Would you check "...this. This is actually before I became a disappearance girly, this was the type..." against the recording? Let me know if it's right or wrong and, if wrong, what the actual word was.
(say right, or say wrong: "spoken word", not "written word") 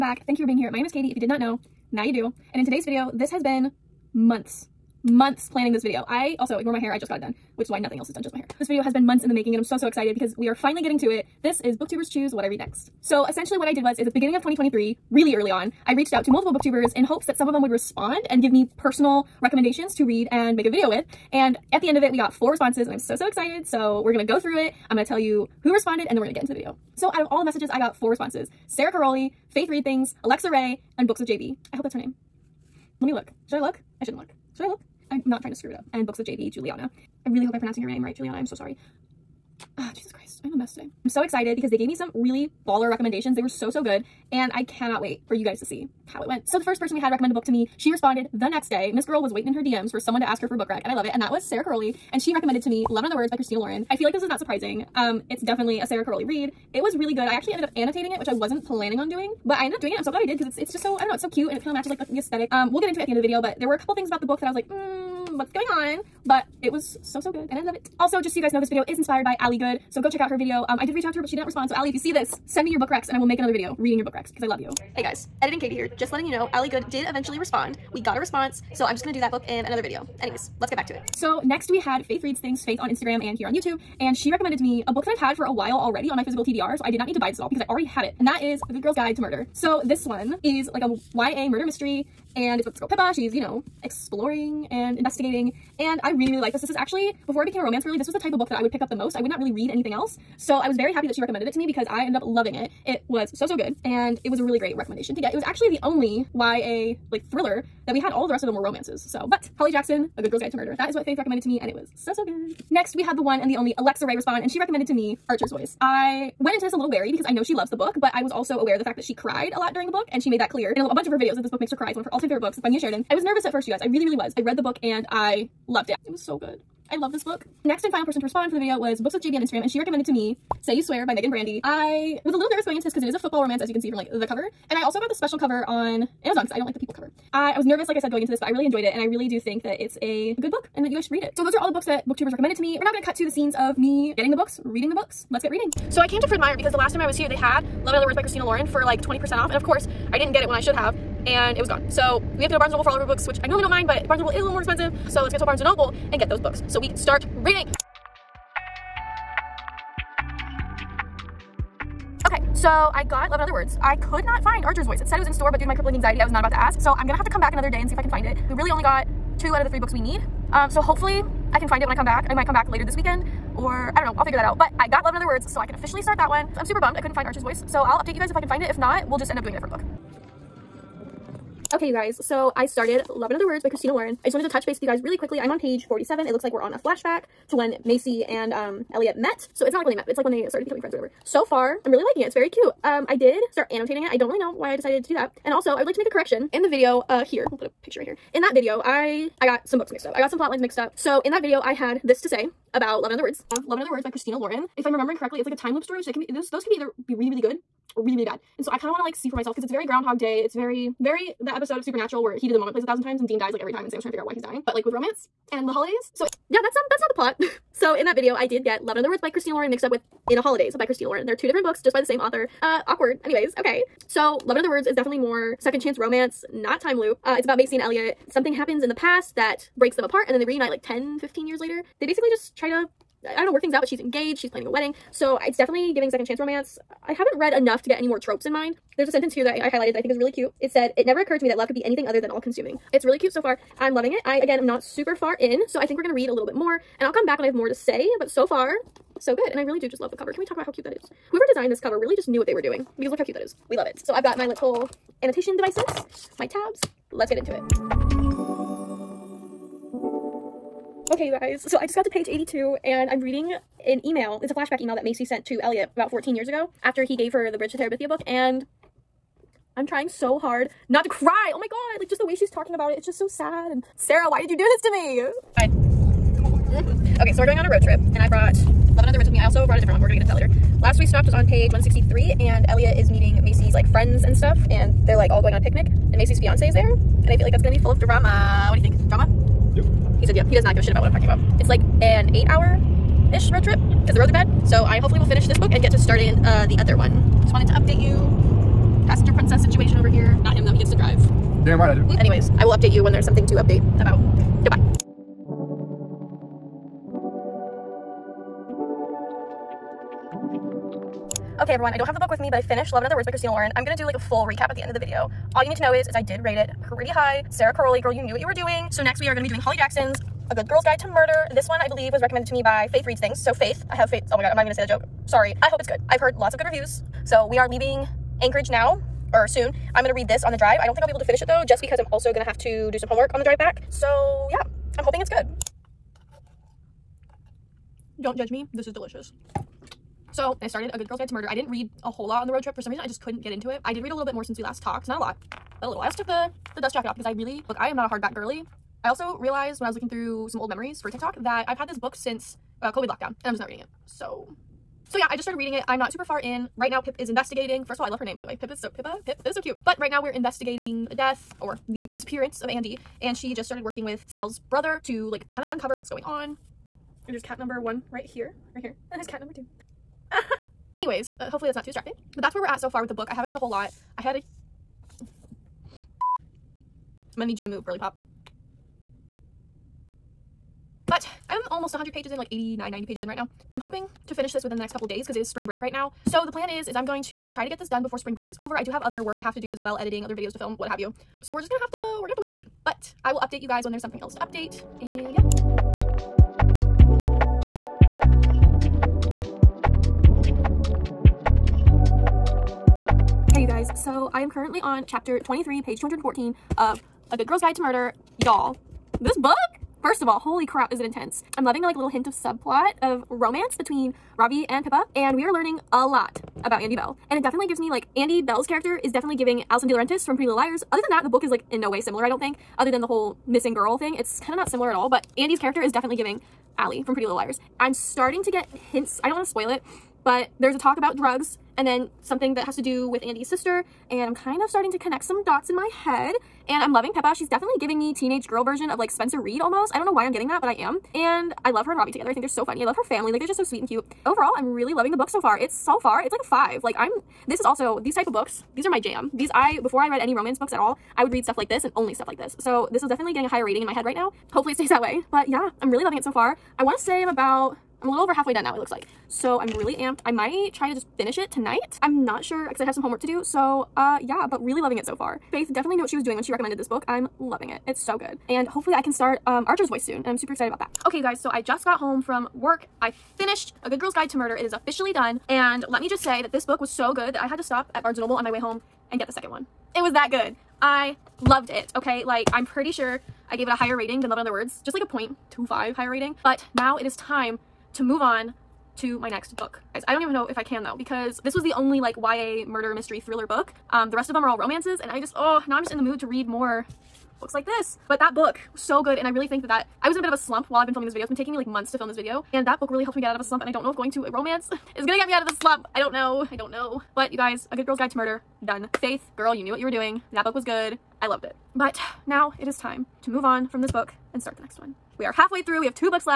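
wrong: "romance", not "disappearance".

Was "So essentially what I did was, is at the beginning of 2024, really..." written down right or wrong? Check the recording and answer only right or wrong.
wrong.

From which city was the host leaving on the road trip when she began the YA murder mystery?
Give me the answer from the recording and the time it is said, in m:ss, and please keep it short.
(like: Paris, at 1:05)
Anchorage, at 5:28.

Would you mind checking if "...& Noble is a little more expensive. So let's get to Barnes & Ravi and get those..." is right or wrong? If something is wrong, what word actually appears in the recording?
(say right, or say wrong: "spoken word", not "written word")
wrong: "Noble", not "Ravi".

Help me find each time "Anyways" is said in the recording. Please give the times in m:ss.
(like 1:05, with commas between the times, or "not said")
1:20, 3:43, 5:02, 6:10.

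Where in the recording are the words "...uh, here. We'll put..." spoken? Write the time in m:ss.
3:17.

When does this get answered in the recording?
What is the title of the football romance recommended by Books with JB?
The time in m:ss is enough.
2:10.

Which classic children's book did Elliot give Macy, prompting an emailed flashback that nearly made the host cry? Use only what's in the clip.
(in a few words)
Bridge to Terabithia.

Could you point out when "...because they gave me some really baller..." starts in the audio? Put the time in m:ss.
0:41.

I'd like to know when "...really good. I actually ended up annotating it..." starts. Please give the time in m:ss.
0:56.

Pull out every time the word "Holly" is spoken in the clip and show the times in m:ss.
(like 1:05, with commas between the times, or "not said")
1:49, 5:19.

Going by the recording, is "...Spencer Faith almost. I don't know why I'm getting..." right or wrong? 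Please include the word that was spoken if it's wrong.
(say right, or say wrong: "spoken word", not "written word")
wrong: "Reid", not "Faith".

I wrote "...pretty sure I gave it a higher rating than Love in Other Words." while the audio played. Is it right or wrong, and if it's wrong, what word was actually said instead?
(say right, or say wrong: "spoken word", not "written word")
right.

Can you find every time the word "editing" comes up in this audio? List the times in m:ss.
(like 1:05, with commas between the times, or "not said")
1:15, 6:29.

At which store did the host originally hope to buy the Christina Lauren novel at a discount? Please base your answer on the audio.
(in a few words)
Fred Meyer.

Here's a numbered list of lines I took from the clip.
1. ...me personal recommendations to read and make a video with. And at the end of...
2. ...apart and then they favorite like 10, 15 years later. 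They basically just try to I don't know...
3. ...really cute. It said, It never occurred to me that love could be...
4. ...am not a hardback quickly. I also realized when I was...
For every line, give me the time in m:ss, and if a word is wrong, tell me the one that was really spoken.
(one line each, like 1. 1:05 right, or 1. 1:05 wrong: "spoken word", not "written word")
1. 0:18 right
2. 3:50 wrong: "reunite", not "favorite"
3. 4:00 right
4. 5:47 wrong: "girly", not "quickly".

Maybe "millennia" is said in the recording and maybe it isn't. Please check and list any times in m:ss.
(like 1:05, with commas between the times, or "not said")
not said.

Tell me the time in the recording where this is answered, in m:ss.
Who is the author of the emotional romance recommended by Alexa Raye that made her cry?
2:02.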